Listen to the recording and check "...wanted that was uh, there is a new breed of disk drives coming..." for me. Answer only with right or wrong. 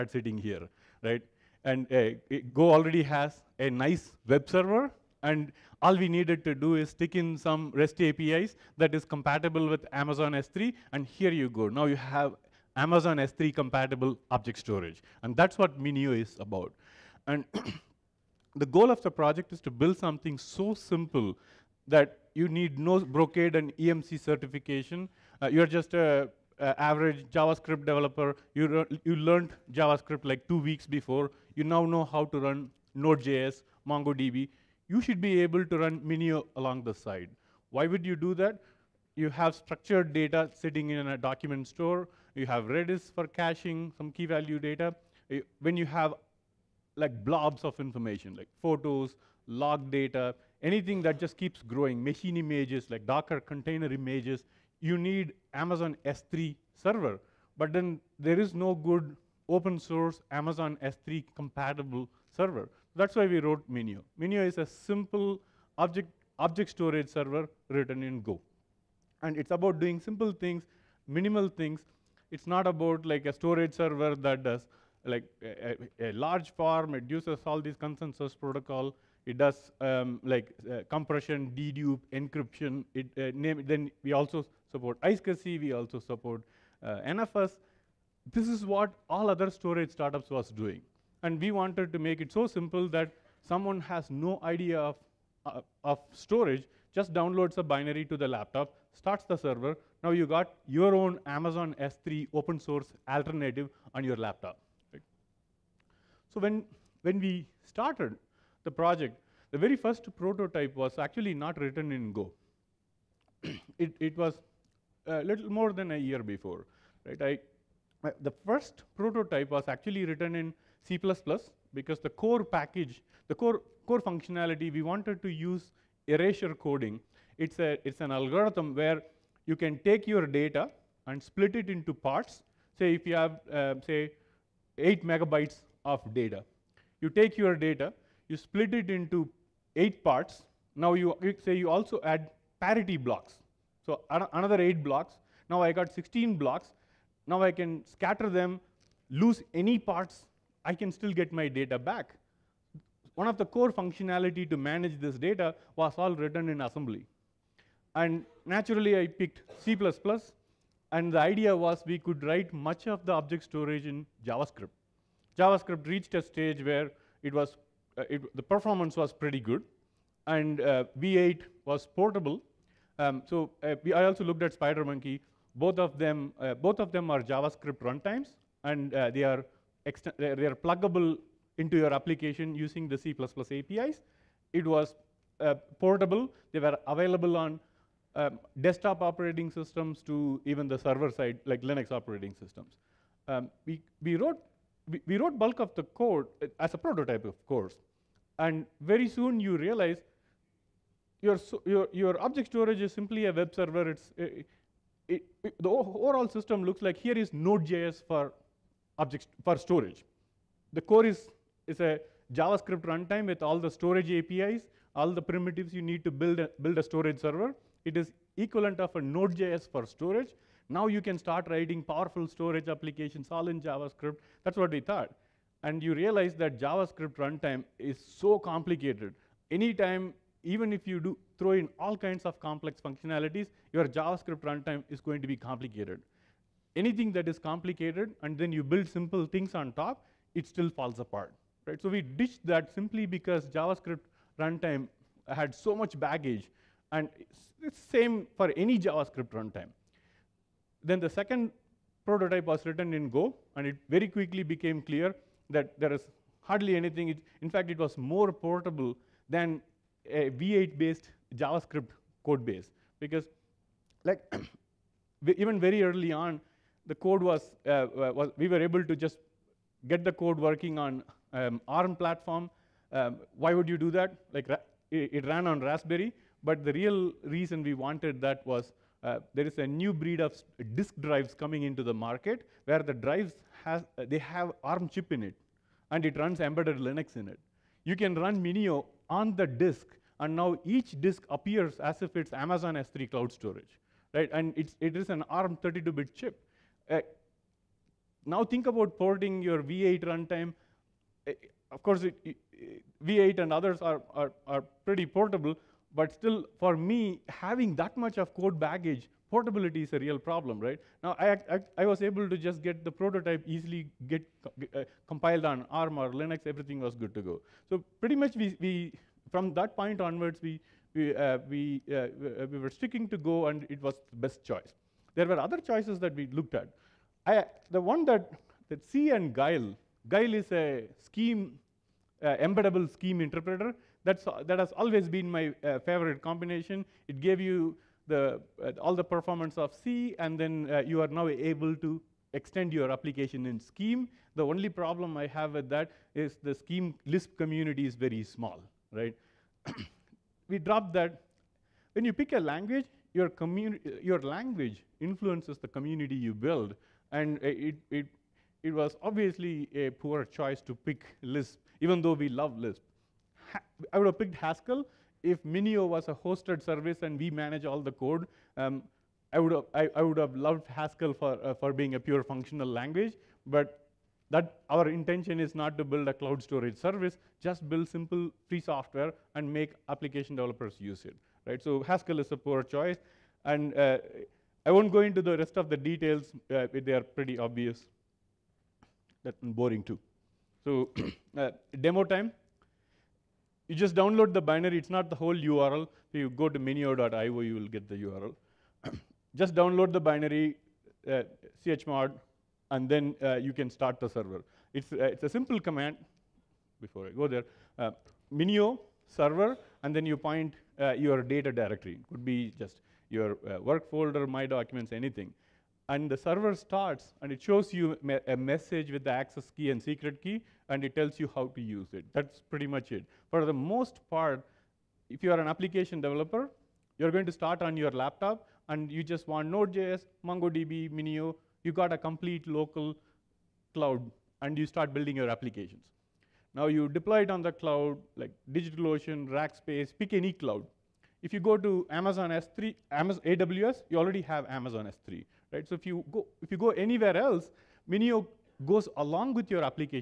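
right.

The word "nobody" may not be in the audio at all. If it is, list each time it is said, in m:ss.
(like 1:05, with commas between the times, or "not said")
not said.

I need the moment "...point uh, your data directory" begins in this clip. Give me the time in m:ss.
6:50.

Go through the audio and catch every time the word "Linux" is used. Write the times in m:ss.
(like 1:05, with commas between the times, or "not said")
3:11, 4:46, 5:16.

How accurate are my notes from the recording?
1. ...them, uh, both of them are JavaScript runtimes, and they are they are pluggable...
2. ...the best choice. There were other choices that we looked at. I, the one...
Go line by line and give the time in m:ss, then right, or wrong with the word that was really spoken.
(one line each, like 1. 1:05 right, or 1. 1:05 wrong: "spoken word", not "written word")
1. 2:55 right
2. 5:24 right.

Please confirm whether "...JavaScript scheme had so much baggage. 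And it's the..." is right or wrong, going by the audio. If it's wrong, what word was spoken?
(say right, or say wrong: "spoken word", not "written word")
wrong: "runtime", not "scheme".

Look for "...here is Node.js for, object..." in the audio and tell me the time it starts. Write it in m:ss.
3:26.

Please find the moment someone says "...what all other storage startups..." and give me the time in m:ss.
1:28.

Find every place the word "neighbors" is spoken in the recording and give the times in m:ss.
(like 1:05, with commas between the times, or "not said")
not said.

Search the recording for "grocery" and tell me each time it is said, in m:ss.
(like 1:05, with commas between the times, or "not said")
not said.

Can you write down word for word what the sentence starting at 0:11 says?
Now you have Amazon S3 compatible object storage.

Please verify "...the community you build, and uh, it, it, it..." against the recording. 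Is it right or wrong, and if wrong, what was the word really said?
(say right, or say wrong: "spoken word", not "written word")
right.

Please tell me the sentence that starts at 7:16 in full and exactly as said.
Now you deploy it on the cloud, like DigitalOcean, Rackspace, pick any cloud.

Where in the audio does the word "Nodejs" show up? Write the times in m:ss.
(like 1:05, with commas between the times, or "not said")
0:32, 3:27, 3:39, 7:09.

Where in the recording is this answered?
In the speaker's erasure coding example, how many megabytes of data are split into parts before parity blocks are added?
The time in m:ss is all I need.
2:14.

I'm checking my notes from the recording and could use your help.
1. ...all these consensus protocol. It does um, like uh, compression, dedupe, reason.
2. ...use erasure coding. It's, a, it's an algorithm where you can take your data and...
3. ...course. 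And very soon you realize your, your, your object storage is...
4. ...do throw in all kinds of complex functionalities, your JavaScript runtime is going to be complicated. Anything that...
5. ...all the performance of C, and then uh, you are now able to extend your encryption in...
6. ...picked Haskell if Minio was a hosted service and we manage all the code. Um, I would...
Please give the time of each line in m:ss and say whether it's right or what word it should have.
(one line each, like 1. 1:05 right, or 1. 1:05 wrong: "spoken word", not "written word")
1. 1:17 wrong: "encryption", not "reason"
2. 2:05 right
3. 3:17 right
4. 3:51 right
5. 5:38 wrong: "application", not "encryption"
6. 6:04 right.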